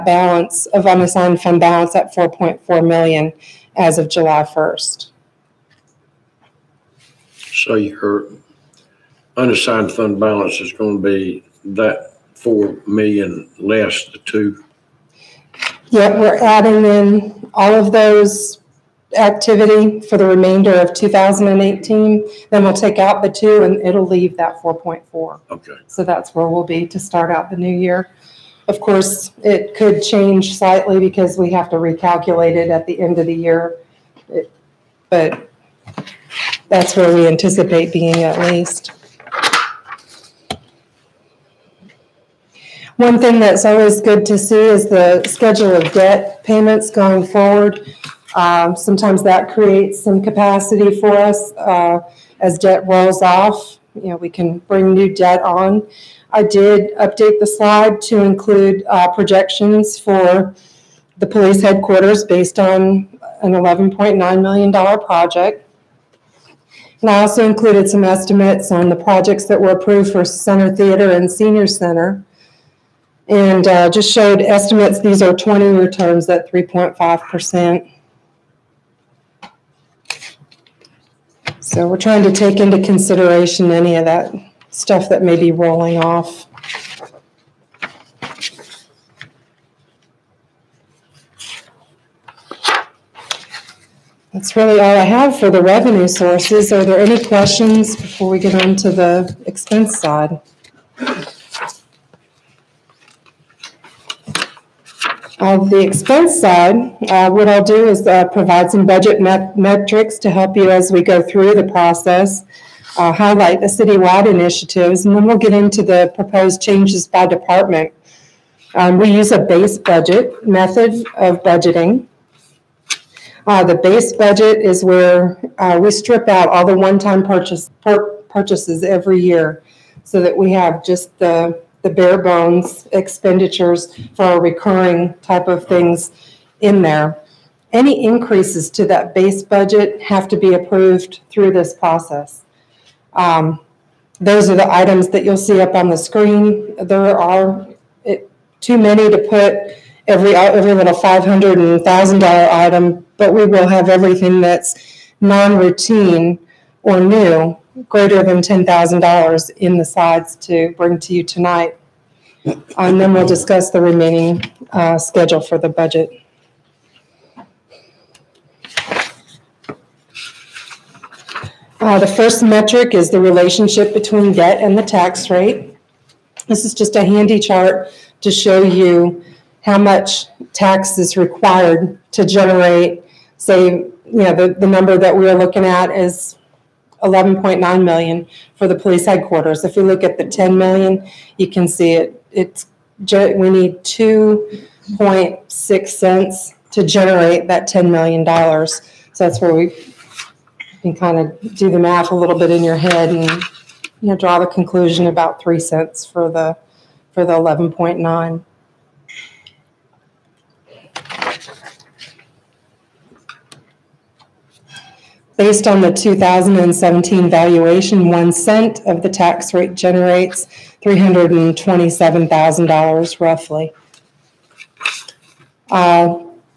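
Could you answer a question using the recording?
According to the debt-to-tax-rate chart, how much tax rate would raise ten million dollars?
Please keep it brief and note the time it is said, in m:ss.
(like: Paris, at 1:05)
2.6 cents, at 3:13.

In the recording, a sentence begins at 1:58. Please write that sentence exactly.
Um, we use a base budget method of budgeting.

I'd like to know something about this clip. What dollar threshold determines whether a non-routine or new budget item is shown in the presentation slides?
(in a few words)
$10,000.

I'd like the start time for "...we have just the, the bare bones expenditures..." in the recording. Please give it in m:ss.
2:10.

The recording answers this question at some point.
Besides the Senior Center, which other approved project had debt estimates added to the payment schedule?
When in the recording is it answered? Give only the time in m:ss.
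1:10.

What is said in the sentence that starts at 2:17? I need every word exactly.
Any increases to that base budget have to be approved through this process.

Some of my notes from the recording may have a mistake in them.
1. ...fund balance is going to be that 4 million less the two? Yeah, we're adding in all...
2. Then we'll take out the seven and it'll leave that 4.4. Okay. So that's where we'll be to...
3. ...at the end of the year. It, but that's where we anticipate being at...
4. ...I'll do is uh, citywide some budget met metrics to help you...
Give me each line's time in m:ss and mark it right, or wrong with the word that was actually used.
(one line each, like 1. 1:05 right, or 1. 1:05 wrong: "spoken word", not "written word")
1. 0:09 right
2. 0:22 wrong: "two", not "seven"
3. 0:32 right
4. 1:47 wrong: "provide", not "citywide".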